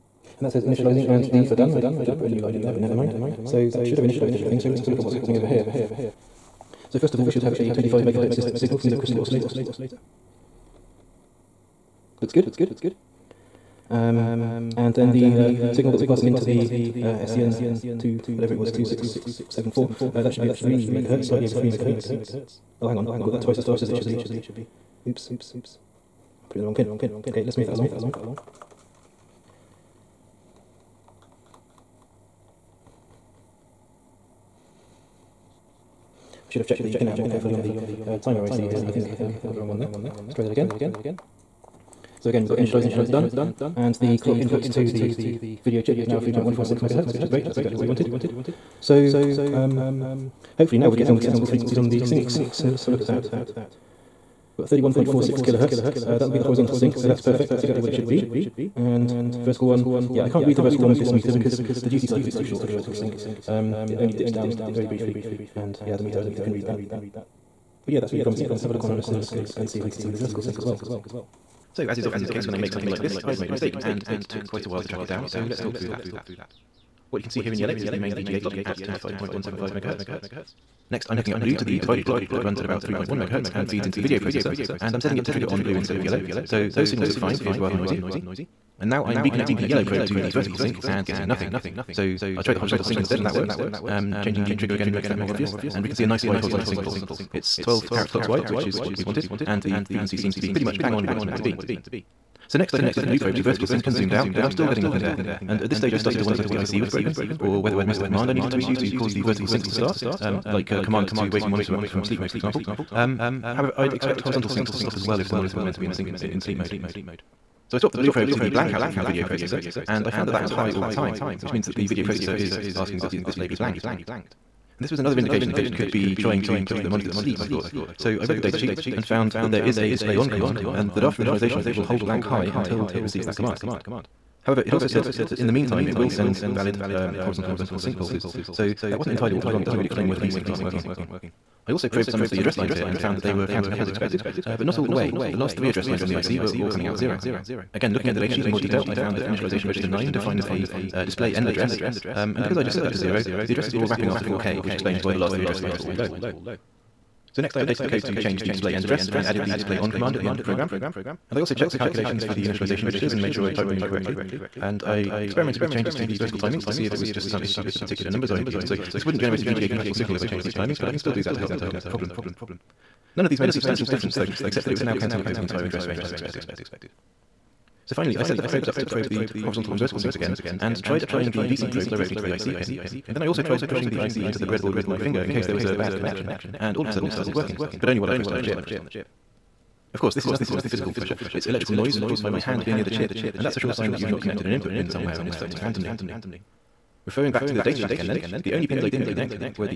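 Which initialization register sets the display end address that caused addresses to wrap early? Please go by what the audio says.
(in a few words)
Register 9.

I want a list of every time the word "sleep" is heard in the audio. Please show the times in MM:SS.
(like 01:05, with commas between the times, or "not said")
01:52, 01:56, 02:07.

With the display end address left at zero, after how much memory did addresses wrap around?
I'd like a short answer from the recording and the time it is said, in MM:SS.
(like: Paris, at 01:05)
4K, at 02:34.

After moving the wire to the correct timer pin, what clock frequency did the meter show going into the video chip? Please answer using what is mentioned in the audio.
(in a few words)
3.146 MHz.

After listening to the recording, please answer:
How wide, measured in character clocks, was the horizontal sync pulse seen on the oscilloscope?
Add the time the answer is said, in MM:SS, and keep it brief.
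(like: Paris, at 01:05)
12, at 01:37.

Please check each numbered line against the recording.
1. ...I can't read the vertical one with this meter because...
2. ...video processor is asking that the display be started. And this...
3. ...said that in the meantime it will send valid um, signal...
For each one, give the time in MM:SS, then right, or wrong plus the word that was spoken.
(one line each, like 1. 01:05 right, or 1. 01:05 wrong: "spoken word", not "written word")
1. 01:00 right
2. 02:01 wrong: "blanked", not "started"
3. 02:14 wrong: "horizontal", not "signal".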